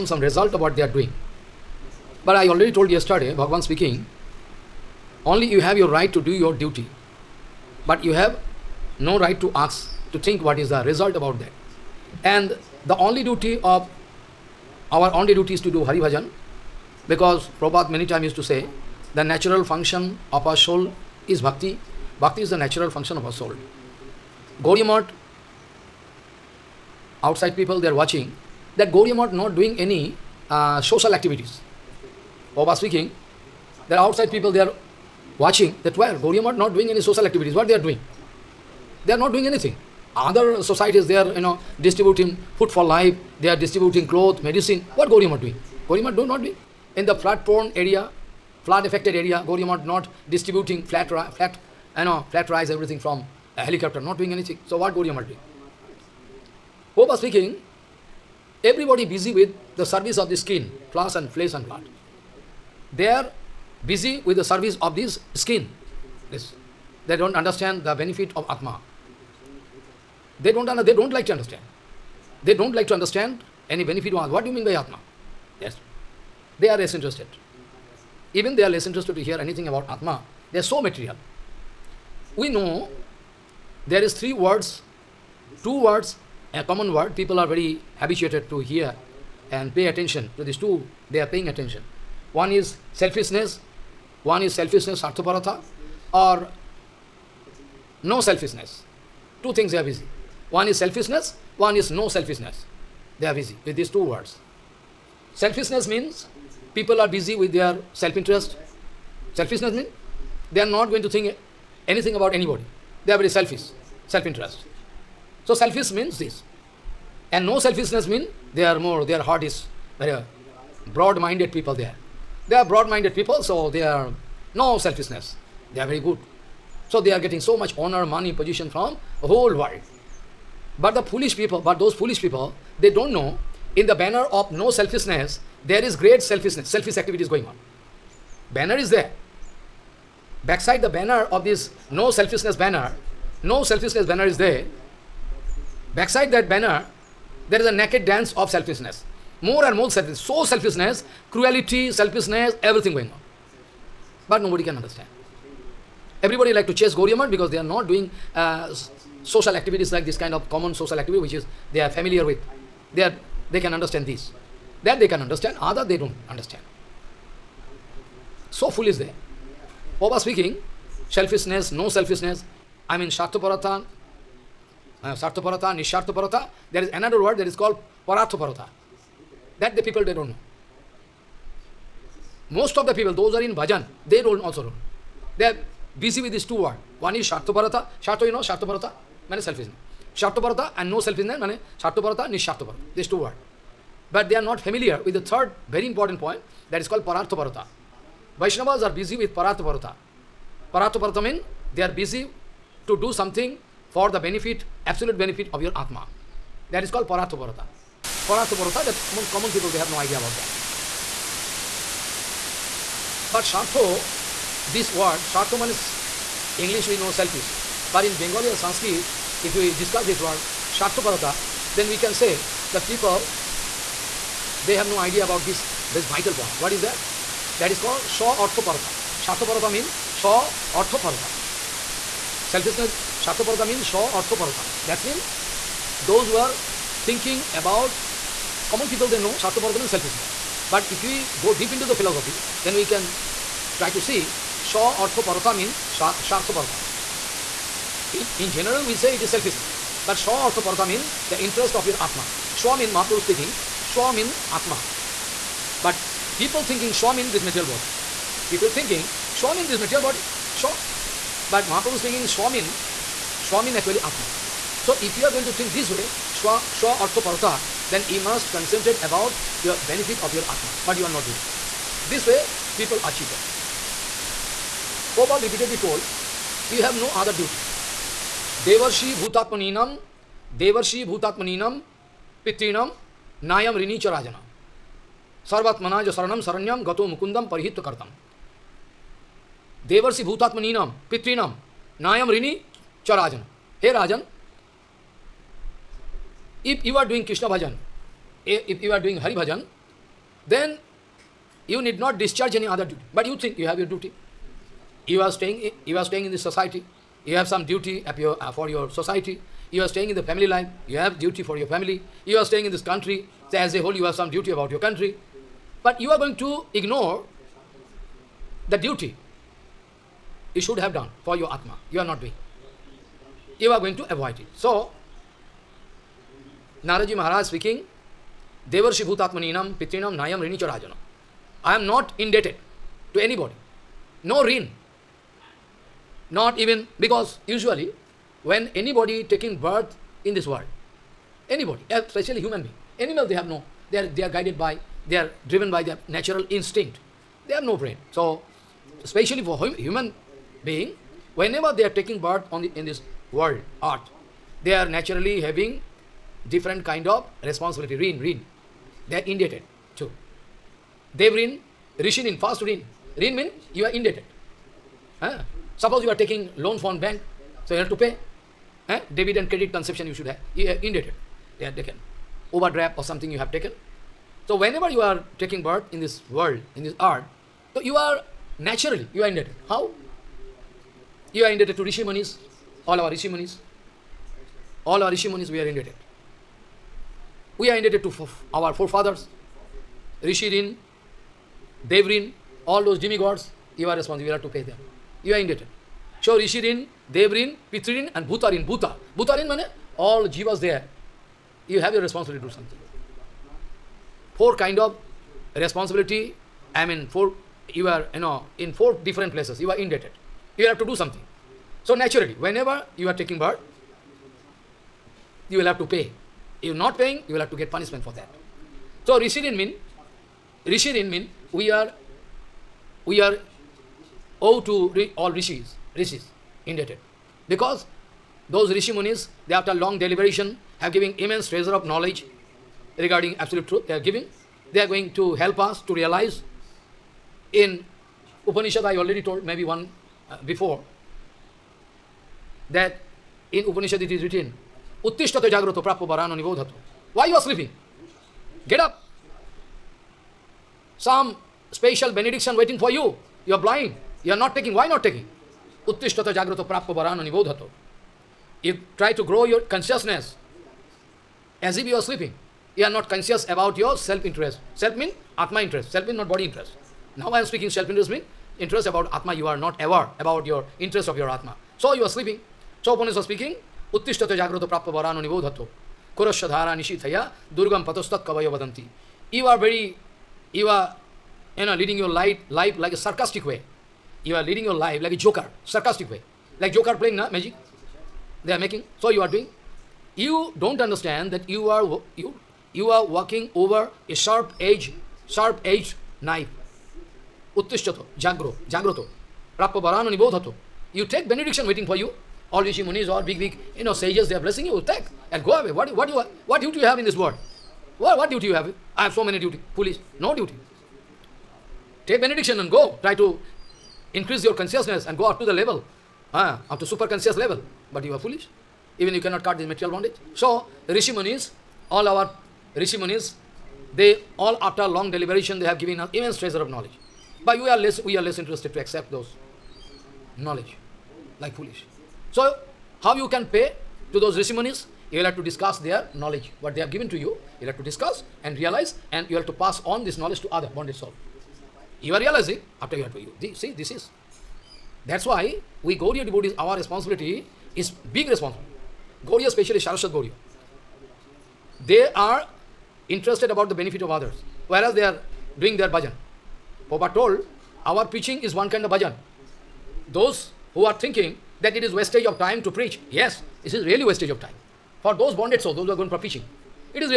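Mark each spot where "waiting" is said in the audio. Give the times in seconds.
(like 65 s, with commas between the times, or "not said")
452 s, 501 s.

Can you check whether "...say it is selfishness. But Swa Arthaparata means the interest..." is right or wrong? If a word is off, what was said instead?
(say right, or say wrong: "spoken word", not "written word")
right.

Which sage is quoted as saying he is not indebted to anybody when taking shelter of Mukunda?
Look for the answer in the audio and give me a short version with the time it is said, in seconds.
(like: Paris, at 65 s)
Naradji Maharaj, at 326 s.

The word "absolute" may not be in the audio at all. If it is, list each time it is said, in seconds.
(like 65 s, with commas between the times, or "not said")
204 s, 433 s.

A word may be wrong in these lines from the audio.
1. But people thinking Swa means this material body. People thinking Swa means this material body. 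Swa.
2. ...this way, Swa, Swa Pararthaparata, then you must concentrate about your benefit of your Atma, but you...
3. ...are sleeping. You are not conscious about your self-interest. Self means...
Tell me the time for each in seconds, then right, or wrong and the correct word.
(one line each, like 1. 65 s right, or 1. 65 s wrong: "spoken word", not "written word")
1. 255 s right
2. 265 s wrong: "Arthaparata", not "Pararthaparata"
3. 461 s right.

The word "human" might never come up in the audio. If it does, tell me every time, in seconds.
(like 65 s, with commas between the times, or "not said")
342 s, 349 s.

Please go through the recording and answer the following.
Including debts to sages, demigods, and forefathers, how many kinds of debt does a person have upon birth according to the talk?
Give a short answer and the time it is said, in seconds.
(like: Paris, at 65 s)
4, at 404 s.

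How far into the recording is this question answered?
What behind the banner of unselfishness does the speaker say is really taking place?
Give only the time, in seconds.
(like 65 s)
147 s.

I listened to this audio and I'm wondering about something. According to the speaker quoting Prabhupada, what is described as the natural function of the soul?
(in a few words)
Bhakti.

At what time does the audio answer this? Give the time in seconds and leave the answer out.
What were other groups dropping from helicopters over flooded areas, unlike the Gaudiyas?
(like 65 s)
52 s.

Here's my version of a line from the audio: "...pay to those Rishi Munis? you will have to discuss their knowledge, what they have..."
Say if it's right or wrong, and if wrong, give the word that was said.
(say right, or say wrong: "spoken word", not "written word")
right.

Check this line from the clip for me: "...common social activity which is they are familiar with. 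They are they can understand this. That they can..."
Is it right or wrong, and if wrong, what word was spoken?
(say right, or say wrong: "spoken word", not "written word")
right.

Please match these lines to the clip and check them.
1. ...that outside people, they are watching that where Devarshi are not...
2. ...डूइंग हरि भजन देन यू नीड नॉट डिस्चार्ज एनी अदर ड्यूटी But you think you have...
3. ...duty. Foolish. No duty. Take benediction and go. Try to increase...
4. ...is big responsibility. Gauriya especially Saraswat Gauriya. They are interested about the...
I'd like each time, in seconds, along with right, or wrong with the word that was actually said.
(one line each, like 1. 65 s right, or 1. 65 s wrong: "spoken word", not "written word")
1. 33 s wrong: "Gauriam", not "Devarshi"
2. 299 s right
3. 509 s right
4. 547 s right.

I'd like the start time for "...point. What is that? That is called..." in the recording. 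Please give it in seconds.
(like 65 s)
226 s.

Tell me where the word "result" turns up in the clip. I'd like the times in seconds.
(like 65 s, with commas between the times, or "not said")
0 s, 10 s.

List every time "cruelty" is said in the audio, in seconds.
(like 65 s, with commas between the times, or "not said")
151 s.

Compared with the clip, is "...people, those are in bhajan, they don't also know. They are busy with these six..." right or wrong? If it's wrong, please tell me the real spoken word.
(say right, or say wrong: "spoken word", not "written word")
wrong: "two", not "six".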